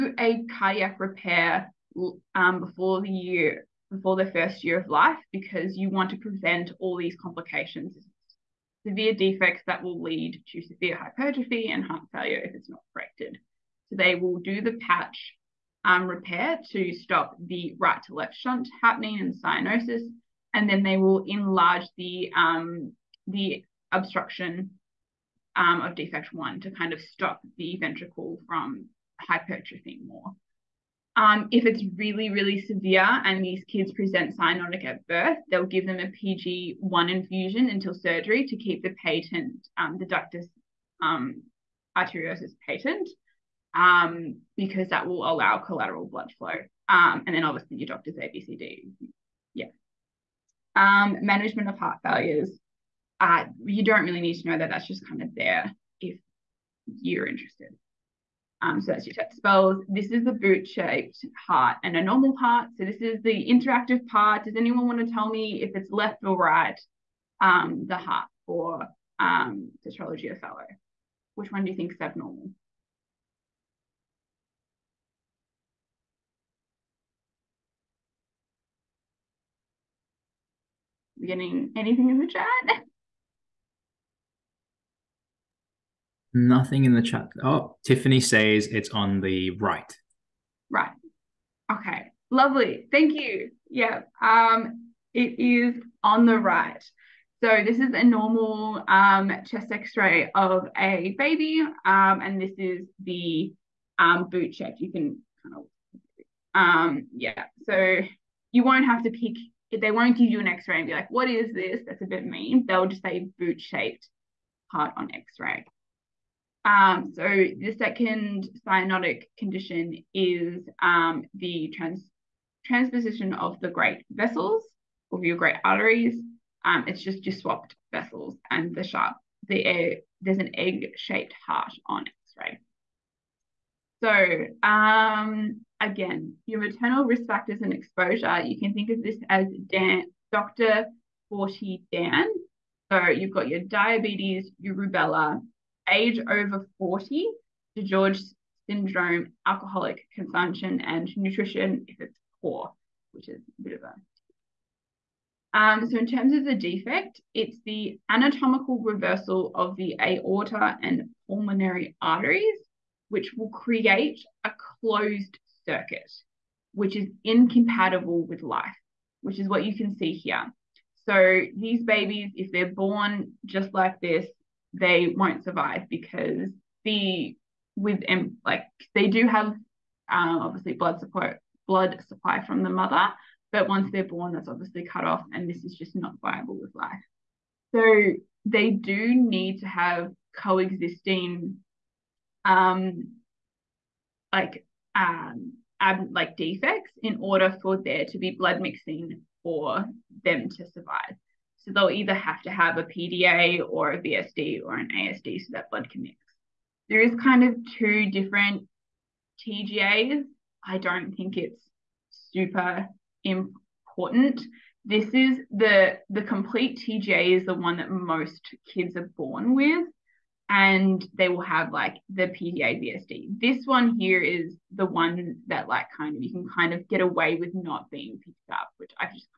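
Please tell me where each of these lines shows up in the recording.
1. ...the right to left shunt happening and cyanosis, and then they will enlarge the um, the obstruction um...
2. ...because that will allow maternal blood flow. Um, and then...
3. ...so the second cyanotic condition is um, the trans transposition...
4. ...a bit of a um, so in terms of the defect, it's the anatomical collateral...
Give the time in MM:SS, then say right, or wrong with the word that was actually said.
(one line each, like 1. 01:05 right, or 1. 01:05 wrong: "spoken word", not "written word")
1. 00:17 right
2. 00:44 wrong: "collateral", not "maternal"
3. 01:57 right
4. 02:33 wrong: "reversal", not "collateral".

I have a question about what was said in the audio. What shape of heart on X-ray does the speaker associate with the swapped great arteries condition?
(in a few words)
Egg-shaped.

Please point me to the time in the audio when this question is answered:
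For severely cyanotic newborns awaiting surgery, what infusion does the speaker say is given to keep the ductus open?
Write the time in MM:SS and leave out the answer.
00:36.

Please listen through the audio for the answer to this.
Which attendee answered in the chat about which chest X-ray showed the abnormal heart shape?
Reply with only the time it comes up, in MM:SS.
01:27.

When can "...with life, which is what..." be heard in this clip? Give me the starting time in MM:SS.
02:48.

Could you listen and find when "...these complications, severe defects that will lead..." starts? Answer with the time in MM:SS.
00:06.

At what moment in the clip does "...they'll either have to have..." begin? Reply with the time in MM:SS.
03:21.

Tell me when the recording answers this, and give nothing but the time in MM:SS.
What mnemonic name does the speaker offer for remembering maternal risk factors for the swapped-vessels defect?
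02:20.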